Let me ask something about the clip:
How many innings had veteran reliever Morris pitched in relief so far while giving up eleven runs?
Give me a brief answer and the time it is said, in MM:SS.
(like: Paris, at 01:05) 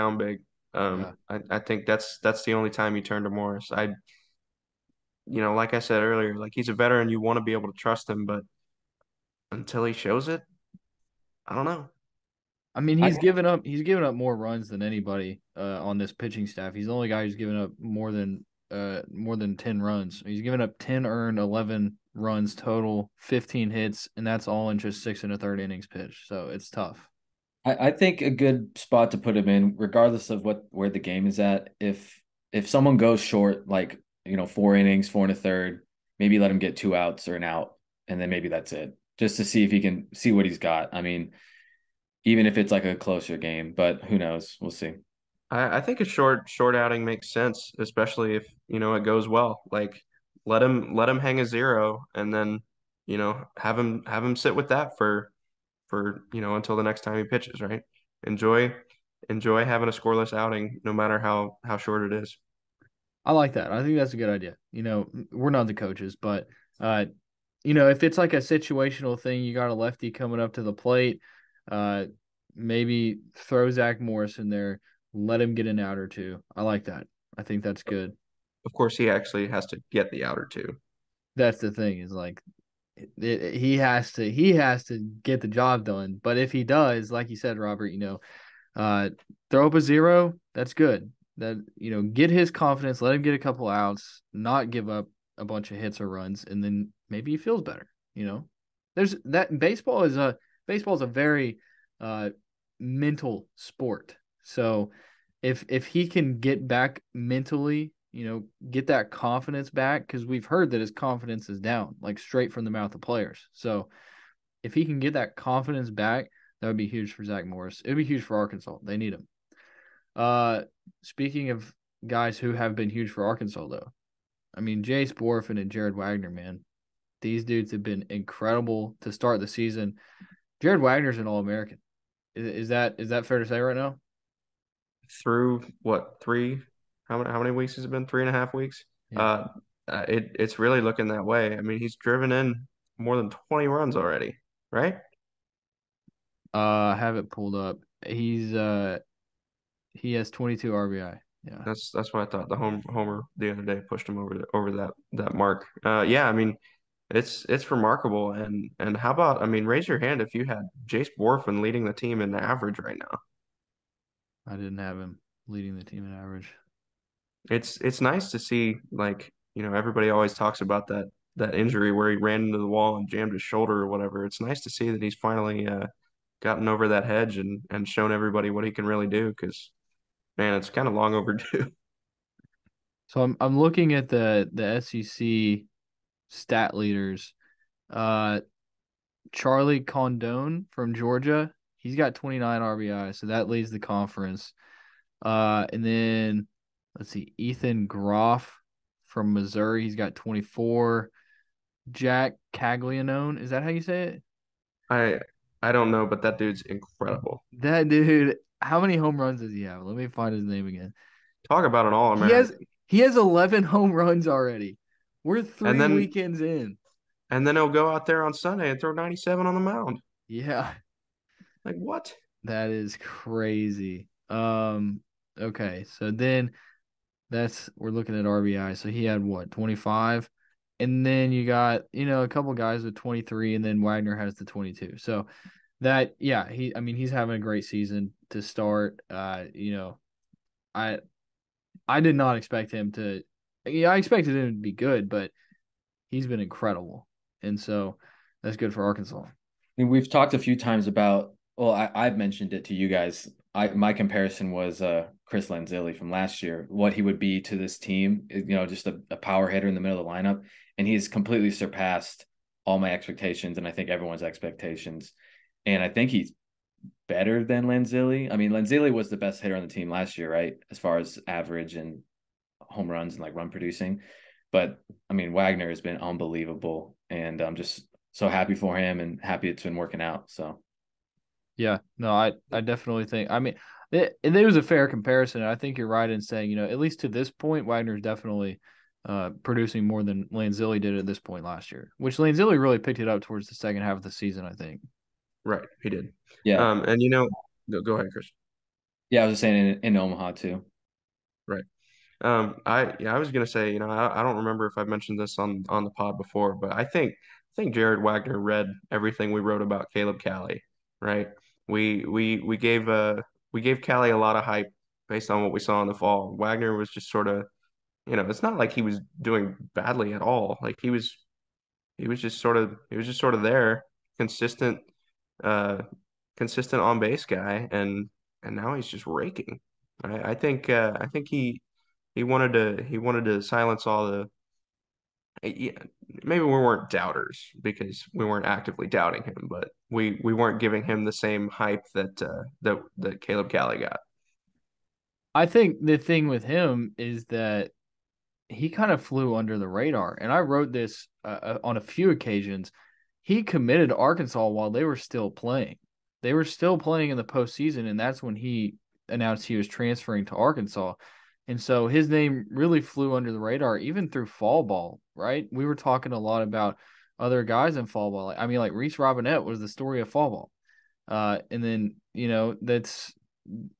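6 1/3, at 00:25.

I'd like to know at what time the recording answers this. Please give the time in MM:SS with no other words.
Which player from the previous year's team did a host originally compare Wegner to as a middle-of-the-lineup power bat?
04:15.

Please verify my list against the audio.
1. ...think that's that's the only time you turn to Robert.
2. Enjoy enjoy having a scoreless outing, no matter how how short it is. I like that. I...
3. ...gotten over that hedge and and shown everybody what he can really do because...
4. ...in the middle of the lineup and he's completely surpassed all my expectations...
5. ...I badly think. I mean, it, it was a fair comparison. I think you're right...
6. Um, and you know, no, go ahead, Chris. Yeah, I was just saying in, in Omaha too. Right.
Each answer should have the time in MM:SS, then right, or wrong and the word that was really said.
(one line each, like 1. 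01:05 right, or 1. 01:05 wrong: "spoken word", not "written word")
1. 00:01 wrong: "Morris", not "Robert"
2. 00:58 right
3. 02:56 right
4. 04:19 right
5. 04:42 wrong: "definitely", not "badly"
6. 04:56 right.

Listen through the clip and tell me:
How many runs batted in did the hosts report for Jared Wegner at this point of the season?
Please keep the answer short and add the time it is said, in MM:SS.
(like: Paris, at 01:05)
22, at 02:30.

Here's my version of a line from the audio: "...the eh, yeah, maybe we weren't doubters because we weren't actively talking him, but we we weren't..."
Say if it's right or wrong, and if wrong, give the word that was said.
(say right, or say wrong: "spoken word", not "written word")
wrong: "doubting", not "talking".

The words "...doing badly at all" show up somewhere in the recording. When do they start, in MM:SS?
05:19.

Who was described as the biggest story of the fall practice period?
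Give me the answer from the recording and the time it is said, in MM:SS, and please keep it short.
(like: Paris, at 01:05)
Reese Robinette, at 06:08.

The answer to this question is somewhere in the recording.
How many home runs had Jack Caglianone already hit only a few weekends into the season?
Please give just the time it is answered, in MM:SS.
03:33.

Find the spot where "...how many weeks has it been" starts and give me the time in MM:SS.
02:17.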